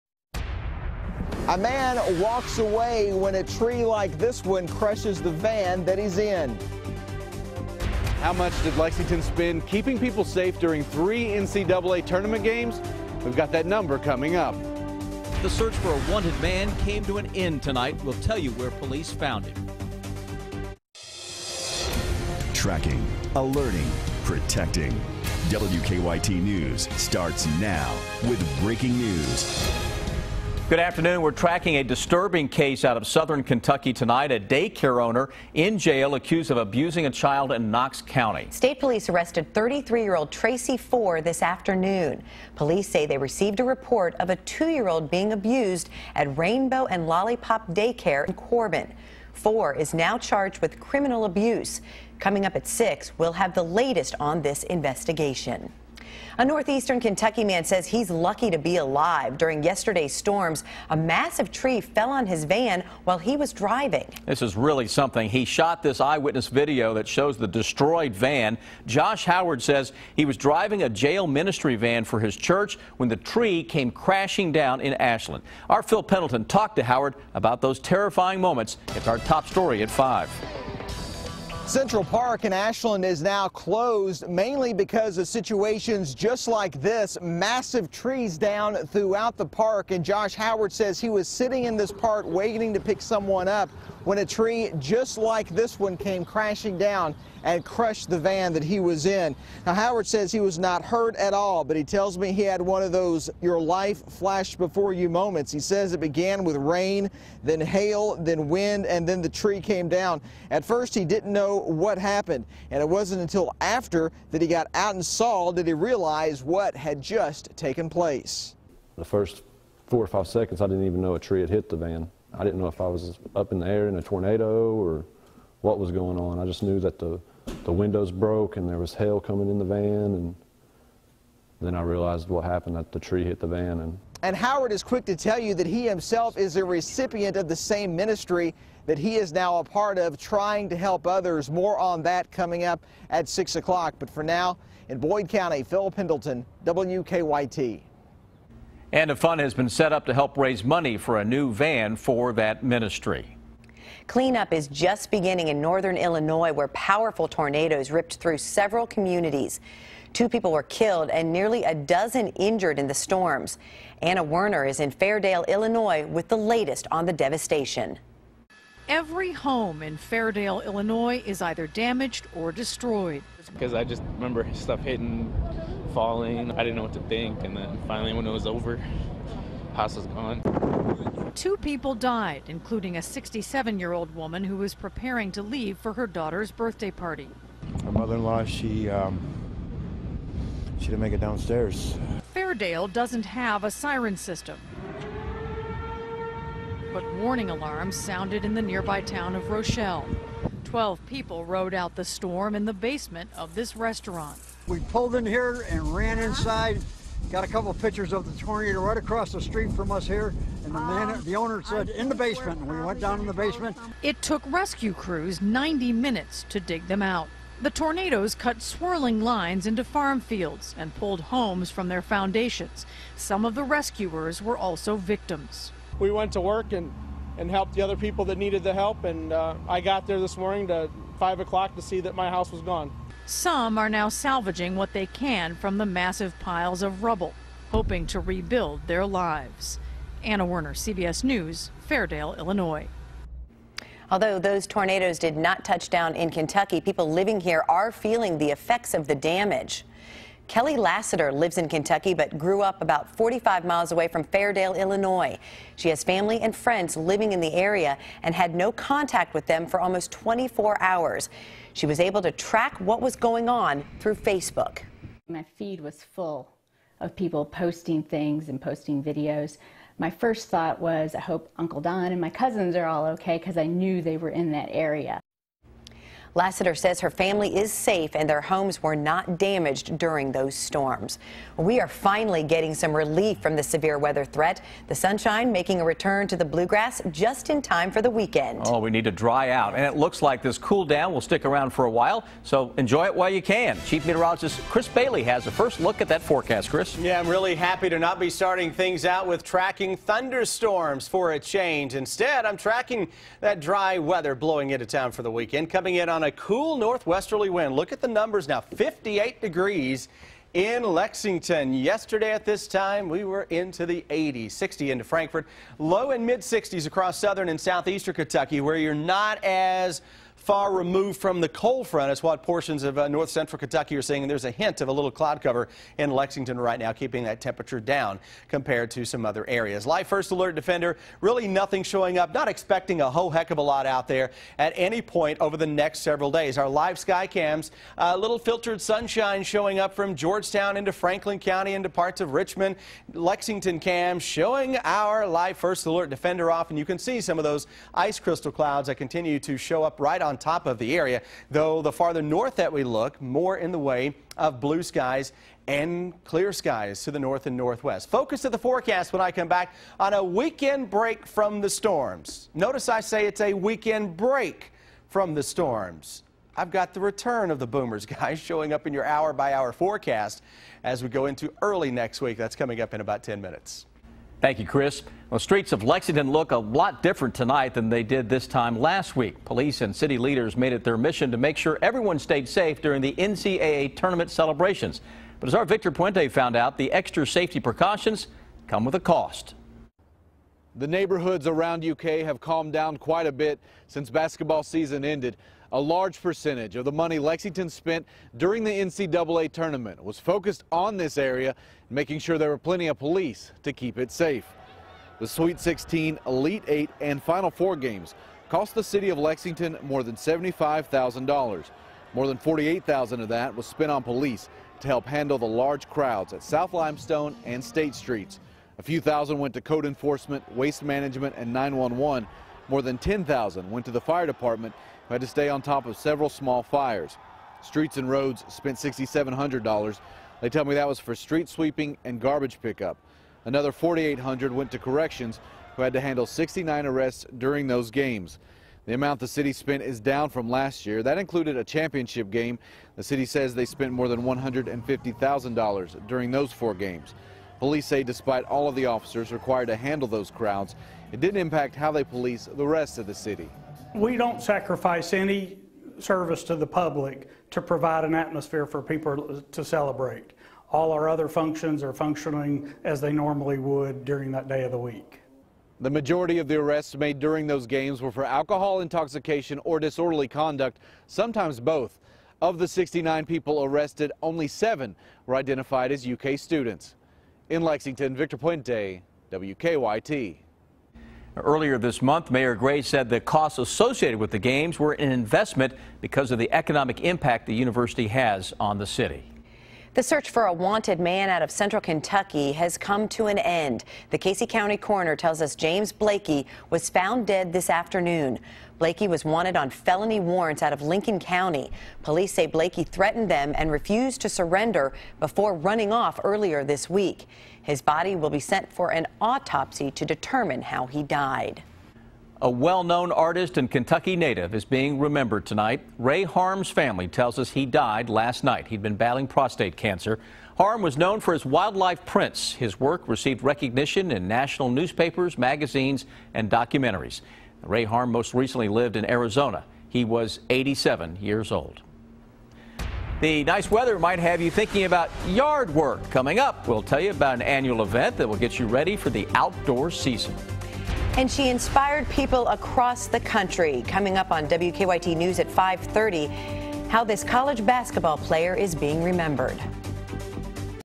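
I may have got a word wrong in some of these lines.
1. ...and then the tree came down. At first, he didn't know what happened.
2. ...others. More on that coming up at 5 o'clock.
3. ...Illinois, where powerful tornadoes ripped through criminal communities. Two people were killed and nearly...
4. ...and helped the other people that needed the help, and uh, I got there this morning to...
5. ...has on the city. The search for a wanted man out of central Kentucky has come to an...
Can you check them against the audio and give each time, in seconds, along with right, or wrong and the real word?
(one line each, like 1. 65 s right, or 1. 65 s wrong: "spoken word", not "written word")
1. 108 s right
2. 141 s wrong: "6", not "5"
3. 155 s wrong: "several", not "criminal"
4. 227 s right
5. 488 s right.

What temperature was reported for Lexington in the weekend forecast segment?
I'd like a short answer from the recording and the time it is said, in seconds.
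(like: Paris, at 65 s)
58 degrees, at 308 s.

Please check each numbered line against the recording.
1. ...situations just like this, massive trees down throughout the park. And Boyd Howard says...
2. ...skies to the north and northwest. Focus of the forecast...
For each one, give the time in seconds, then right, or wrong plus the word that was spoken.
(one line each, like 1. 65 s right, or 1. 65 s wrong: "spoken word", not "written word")
1. 85 s wrong: "Josh", not "Boyd"
2. 356 s right.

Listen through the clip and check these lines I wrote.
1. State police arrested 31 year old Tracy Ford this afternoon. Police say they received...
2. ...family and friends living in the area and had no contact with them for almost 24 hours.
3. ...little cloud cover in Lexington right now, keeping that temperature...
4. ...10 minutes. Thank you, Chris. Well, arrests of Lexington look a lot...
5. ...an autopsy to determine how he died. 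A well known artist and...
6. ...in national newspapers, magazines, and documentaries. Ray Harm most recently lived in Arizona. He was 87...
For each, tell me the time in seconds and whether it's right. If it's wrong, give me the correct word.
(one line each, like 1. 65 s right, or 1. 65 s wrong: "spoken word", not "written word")
1. 38 s wrong: "33", not "31"
2. 256 s right
3. 324 s right
4. 373 s wrong: "streets", not "arrests"
5. 508 s right
6. 524 s right.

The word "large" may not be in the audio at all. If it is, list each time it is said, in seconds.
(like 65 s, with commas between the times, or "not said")
395 s, 415 s.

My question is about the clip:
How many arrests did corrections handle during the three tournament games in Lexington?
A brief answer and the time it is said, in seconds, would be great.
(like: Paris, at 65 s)
69, at 436 s.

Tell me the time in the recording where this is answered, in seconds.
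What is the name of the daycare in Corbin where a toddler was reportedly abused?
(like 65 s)
46 s.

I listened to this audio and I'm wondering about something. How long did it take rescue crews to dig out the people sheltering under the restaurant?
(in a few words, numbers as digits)
90 minutes.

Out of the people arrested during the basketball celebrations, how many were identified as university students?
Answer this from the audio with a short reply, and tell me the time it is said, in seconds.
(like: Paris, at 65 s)
7, at 474 s.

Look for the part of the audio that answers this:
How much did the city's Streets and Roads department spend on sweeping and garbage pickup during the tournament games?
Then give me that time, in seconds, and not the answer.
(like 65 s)
428 s.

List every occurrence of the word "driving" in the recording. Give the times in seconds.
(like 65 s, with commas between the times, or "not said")
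63 s, 70 s.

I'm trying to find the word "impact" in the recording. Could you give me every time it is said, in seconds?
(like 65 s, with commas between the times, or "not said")
451 s, 487 s.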